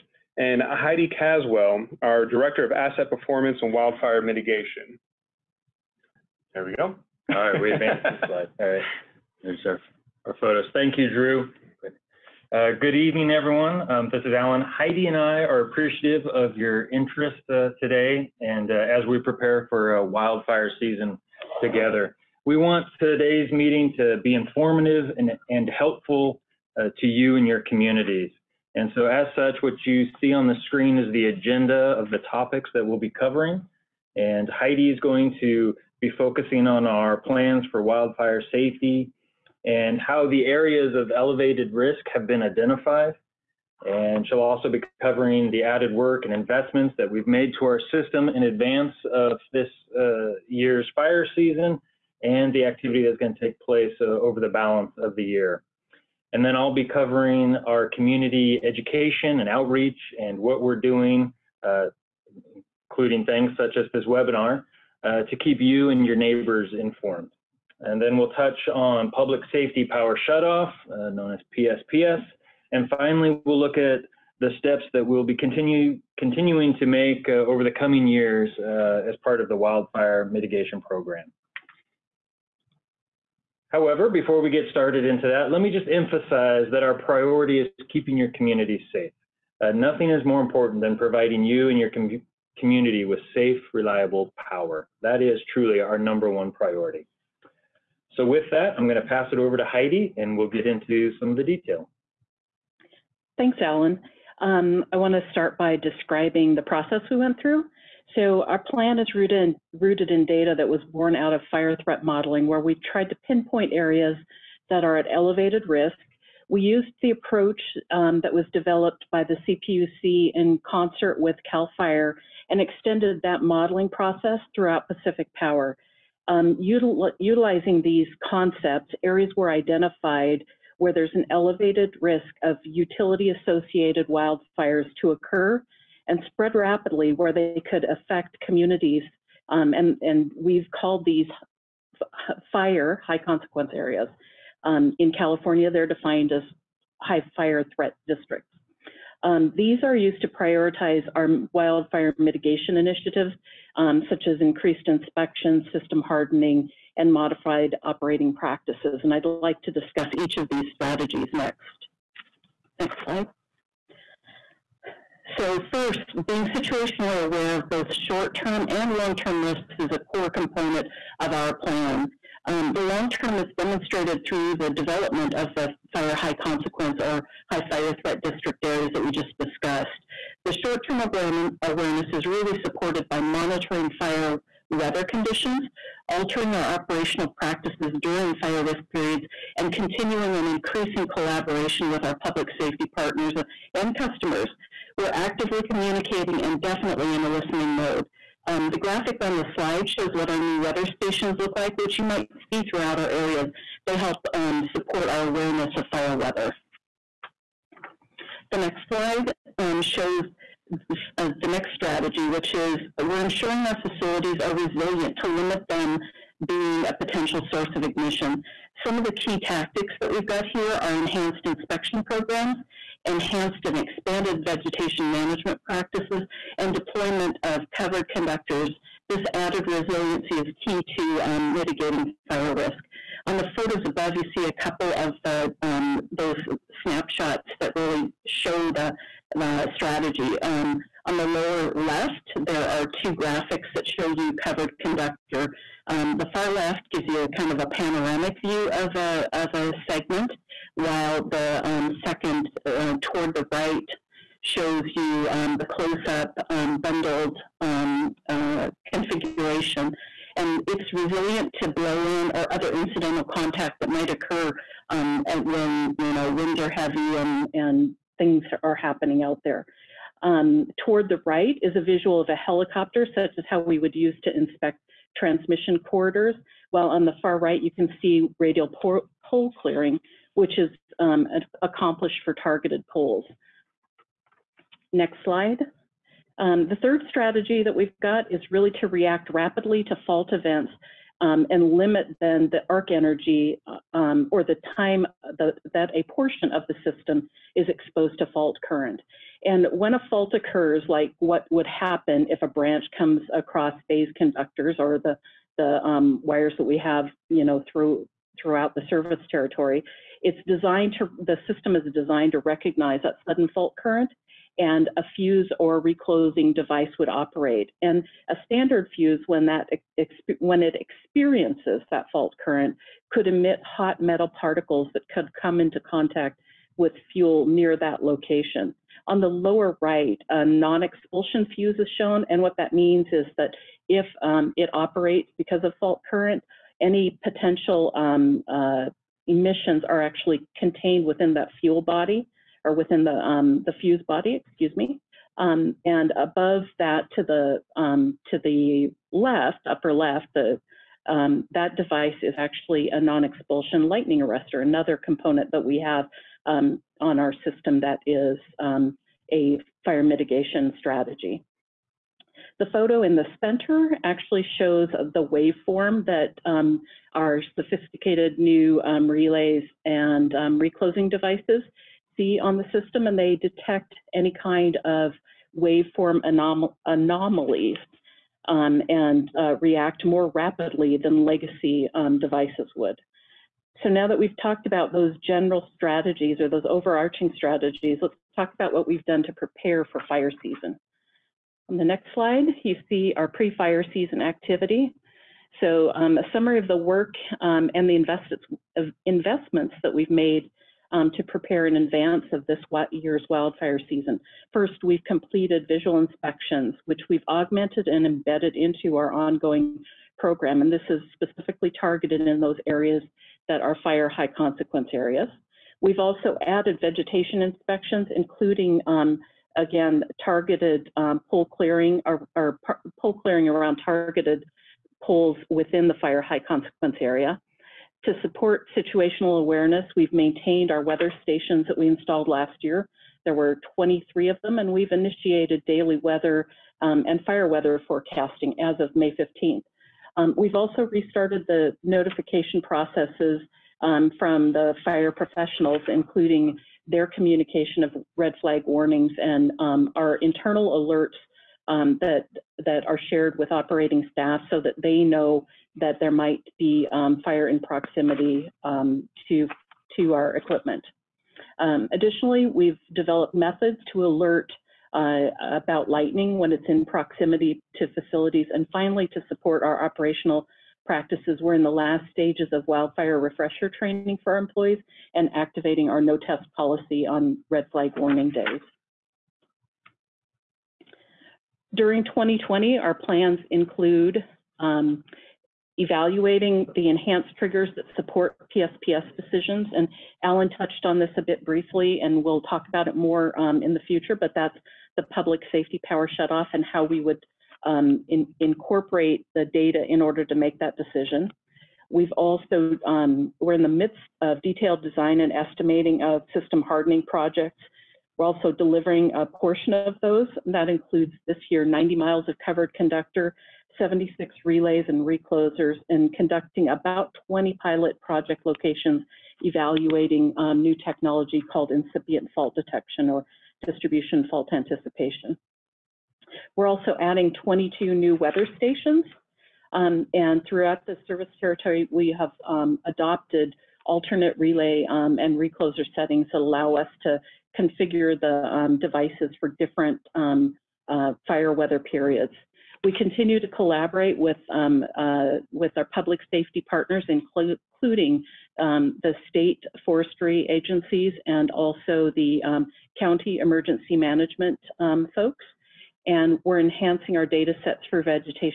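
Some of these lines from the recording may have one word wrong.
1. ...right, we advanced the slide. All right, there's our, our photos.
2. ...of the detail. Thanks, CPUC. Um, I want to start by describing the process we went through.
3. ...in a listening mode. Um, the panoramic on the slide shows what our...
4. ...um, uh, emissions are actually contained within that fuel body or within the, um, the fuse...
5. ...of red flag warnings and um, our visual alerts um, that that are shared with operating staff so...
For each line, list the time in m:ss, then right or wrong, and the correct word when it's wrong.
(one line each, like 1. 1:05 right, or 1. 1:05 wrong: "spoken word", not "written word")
1. 0:07 right
2. 1:41 wrong: "Alan", not "CPUC"
3. 3:17 wrong: "graphic", not "panoramic"
4. 5:37 right
5. 7:27 wrong: "internal", not "visual".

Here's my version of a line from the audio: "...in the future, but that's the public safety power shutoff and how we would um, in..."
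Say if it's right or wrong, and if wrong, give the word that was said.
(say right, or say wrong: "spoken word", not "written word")
right.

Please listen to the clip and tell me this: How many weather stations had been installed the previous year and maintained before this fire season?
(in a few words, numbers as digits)
23.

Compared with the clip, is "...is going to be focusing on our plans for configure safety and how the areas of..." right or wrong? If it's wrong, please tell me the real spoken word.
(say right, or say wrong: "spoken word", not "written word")
wrong: "wildfire", not "configure".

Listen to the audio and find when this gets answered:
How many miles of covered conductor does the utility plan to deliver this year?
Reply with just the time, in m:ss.
8:31.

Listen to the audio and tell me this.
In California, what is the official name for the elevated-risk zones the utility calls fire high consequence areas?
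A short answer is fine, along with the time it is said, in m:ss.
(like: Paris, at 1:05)
high fire threat districts, at 2:27.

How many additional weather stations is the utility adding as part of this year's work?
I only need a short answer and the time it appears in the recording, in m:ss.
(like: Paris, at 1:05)
22, at 8:47.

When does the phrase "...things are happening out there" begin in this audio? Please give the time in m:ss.
4:28.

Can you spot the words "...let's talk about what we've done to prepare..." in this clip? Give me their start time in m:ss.
6:28.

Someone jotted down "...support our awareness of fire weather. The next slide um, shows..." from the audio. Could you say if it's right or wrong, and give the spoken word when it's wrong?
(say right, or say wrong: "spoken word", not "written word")
right.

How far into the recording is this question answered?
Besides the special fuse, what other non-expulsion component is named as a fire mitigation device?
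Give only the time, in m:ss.
5:53.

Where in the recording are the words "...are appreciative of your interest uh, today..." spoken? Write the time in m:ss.
0:15.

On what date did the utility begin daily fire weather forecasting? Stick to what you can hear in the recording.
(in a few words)
May 15.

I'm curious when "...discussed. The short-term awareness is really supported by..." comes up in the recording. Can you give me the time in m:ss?
2:59.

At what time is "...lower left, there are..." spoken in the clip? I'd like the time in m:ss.
4:01.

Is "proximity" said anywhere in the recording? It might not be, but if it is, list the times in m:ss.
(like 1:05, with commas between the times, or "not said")
7:37, 7:46.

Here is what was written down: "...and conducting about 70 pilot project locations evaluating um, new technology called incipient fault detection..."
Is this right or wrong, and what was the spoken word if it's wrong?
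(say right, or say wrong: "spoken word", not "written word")
wrong: "20", not "70".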